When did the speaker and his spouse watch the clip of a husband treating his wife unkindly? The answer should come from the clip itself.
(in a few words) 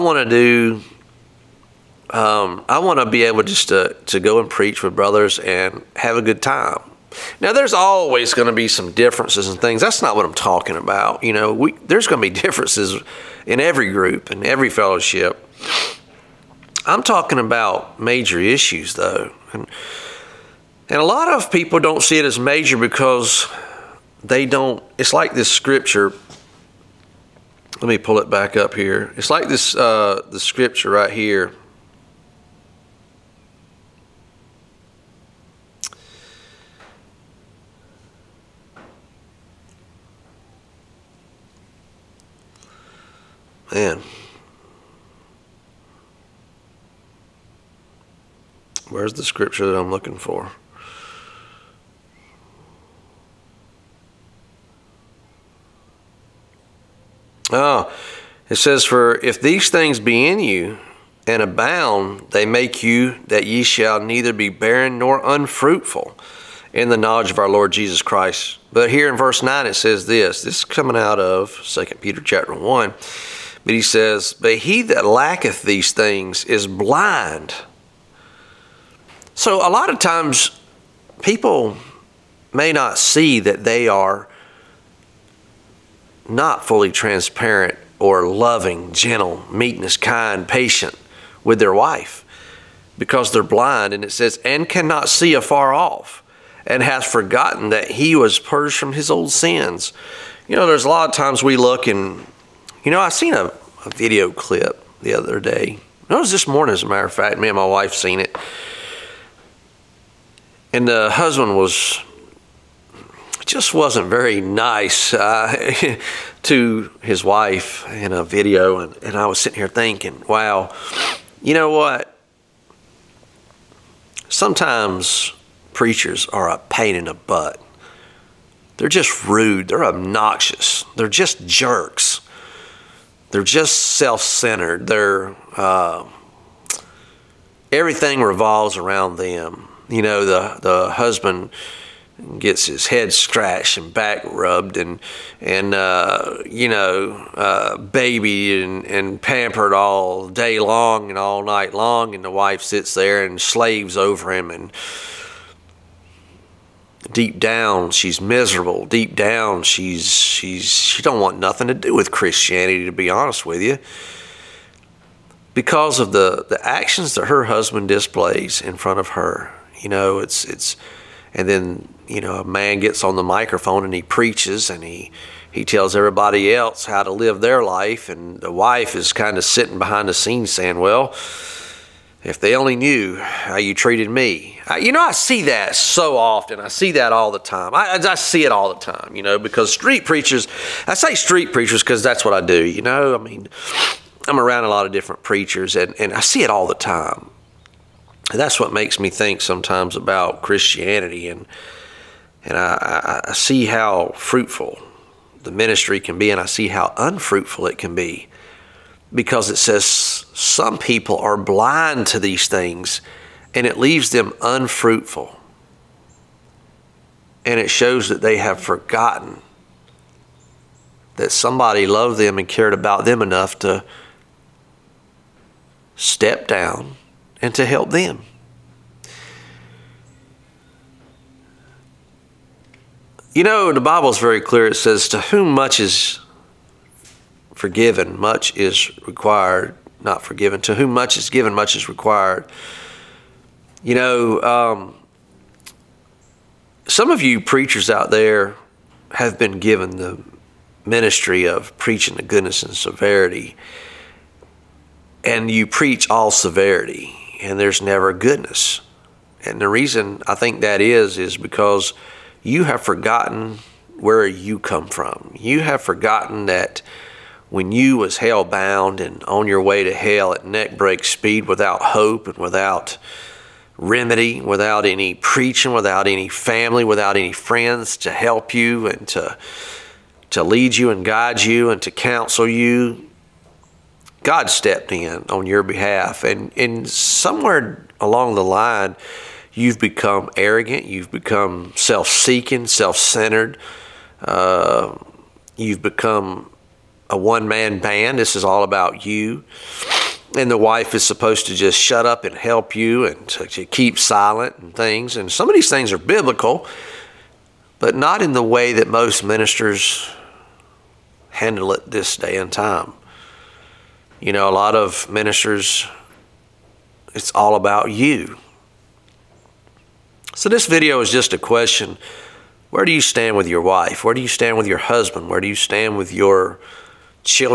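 this morning.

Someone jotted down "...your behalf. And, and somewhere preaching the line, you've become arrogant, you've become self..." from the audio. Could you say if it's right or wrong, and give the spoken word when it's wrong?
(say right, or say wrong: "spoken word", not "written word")
wrong: "along", not "preaching".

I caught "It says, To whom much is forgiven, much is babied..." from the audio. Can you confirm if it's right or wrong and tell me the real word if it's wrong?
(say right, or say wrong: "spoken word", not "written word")
wrong: "required", not "babied".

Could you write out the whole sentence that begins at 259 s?
And the reason I think that is, is because you have forgotten where you come from.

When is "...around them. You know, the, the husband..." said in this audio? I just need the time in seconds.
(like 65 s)
138 s.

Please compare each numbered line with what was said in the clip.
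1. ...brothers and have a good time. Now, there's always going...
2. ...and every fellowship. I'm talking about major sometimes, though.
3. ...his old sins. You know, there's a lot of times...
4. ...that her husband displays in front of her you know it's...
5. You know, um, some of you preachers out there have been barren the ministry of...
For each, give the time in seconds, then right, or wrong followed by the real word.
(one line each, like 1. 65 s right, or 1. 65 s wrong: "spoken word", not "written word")
1. 4 s right
2. 14 s wrong: "issues", not "sometimes"
3. 98 s right
4. 167 s right
5. 243 s wrong: "given", not "barren".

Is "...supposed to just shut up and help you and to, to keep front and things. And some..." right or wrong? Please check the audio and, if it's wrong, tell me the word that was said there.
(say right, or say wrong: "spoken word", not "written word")
wrong: "silent", not "front".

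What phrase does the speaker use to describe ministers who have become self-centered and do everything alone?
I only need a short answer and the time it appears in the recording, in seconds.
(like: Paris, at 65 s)
a one man band, at 297 s.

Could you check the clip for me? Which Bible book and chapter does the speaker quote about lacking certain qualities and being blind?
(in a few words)
2 Peter chapter 1.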